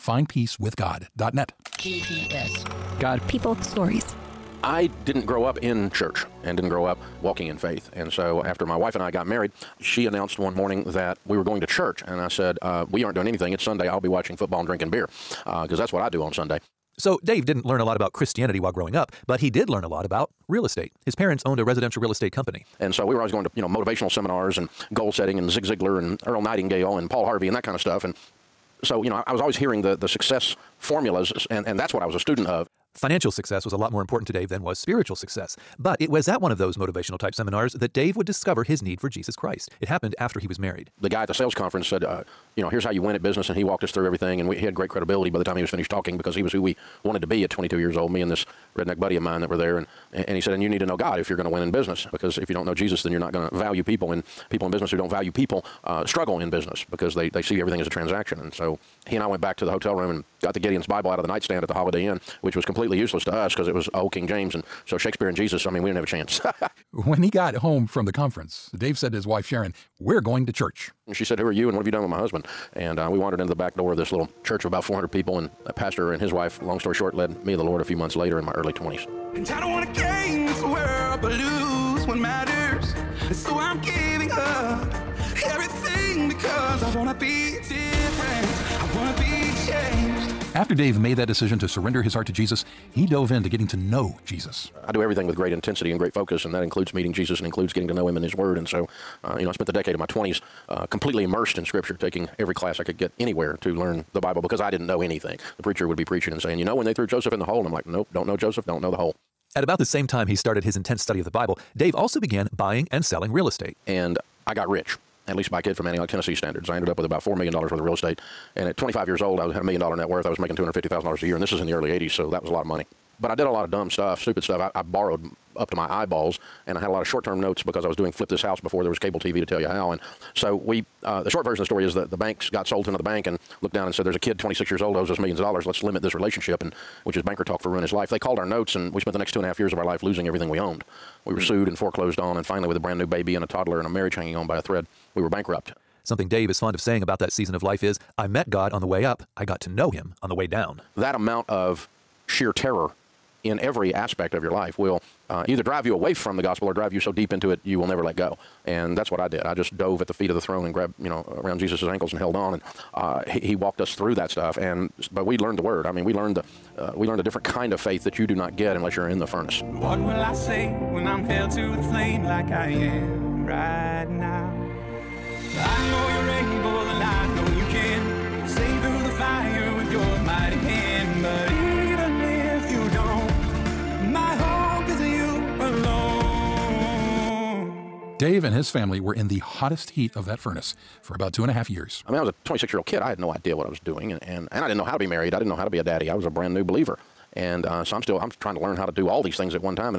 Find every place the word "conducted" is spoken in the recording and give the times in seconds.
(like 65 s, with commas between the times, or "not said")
not said.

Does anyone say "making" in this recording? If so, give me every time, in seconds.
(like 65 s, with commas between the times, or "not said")
120 s.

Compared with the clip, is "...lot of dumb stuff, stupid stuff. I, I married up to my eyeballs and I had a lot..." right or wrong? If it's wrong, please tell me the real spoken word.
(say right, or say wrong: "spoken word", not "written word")
wrong: "borrowed", not "married".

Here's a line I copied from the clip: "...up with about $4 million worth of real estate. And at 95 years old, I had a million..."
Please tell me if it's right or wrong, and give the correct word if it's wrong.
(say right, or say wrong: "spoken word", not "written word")
wrong: "25", not "95".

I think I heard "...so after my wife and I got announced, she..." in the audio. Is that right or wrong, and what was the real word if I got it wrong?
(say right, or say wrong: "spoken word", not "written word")
wrong: "married", not "announced".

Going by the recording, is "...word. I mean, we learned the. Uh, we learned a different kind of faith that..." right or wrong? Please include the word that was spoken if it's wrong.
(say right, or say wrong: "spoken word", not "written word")
right.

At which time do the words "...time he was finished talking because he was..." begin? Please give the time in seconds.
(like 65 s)
45 s.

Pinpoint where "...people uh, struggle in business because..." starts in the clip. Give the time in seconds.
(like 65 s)
55 s.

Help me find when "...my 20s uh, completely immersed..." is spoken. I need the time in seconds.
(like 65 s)
99 s.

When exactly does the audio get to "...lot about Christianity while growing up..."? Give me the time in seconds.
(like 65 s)
17 s.